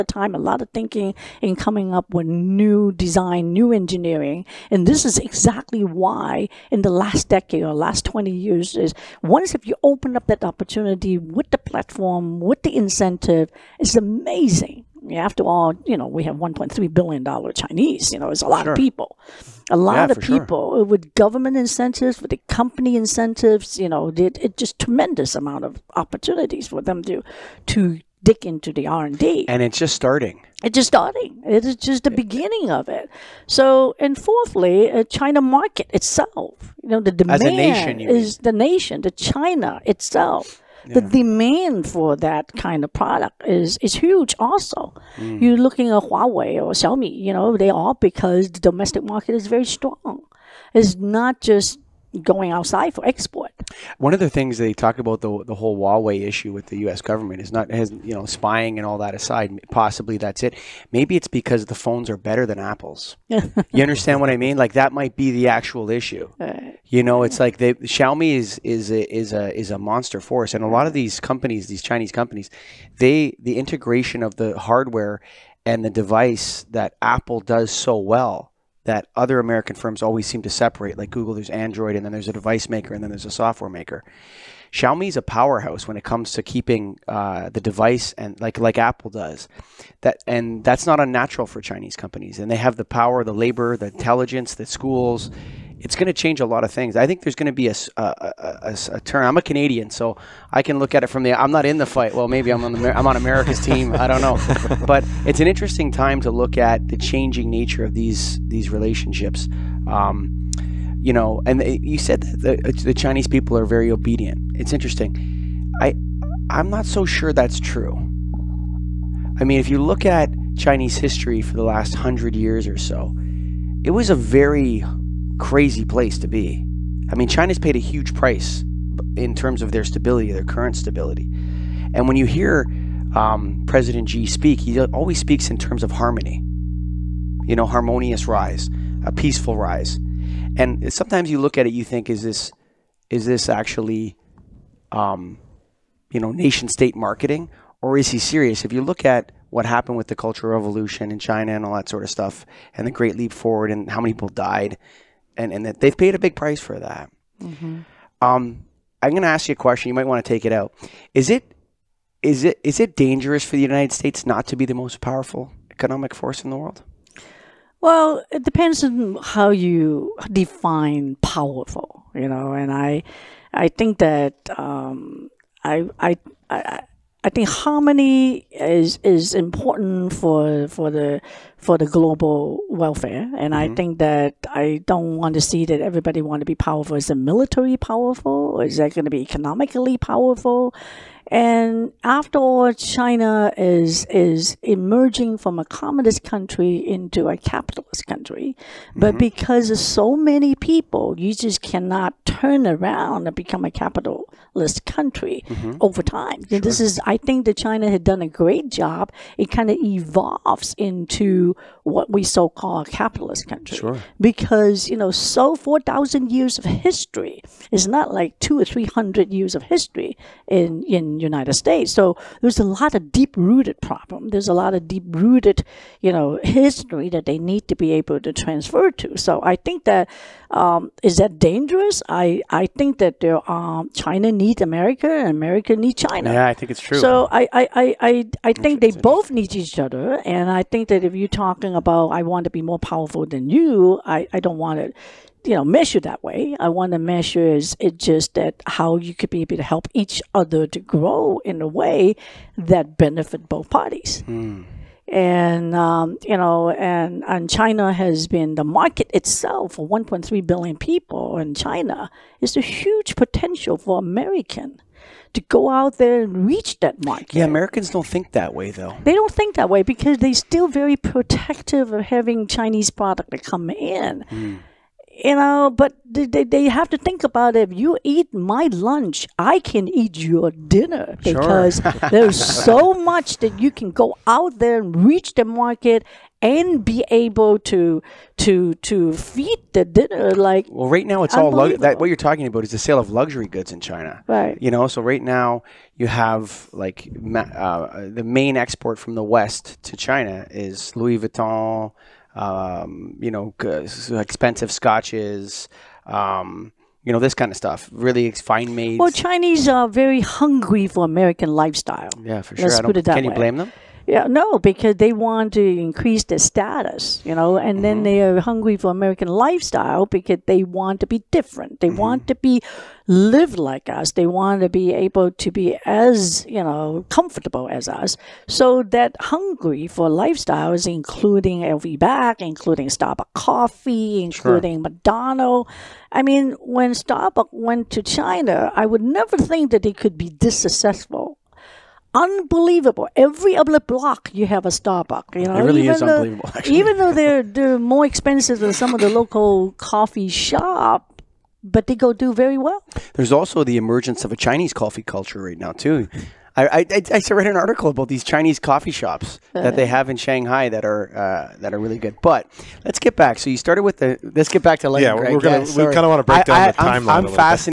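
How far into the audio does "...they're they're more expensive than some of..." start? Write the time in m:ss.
5:47.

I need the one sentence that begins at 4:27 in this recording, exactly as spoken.
Yeah, Americans don't think that way though.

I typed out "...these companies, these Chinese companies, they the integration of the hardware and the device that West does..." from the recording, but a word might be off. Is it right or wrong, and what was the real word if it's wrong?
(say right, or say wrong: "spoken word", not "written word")
wrong: "Apple", not "West".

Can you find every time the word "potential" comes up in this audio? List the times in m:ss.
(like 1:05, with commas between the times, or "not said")
4:23.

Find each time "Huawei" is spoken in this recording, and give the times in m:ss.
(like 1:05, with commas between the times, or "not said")
0:46, 0:55.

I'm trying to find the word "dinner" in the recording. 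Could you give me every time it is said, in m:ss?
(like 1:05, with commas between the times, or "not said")
4:40, 4:49.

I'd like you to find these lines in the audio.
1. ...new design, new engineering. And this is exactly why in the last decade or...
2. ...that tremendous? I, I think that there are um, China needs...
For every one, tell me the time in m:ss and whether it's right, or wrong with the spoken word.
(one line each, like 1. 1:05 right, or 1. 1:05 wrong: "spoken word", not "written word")
1. 0:02 right
2. 3:51 wrong: "dangerous", not "tremendous".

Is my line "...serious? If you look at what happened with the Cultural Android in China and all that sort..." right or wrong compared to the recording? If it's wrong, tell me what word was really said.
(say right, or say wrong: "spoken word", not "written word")
wrong: "Revolution", not "Android".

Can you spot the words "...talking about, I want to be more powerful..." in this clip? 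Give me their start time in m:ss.
4:01.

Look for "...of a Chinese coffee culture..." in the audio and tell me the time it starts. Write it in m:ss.
5:54.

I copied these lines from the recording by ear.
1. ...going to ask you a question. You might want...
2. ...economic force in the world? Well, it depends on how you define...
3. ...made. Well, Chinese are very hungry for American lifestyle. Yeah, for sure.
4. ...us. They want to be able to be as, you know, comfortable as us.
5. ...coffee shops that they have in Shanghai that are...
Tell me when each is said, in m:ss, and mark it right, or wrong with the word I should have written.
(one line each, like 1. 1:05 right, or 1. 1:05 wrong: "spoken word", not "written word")
1. 2:39 right
2. 2:45 right
3. 5:08 right
4. 5:23 right
5. 5:58 right.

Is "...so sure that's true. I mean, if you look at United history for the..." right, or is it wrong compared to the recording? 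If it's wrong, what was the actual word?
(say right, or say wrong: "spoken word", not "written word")
wrong: "Chinese", not "United".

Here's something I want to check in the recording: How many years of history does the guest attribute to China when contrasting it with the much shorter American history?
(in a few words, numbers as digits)
4000.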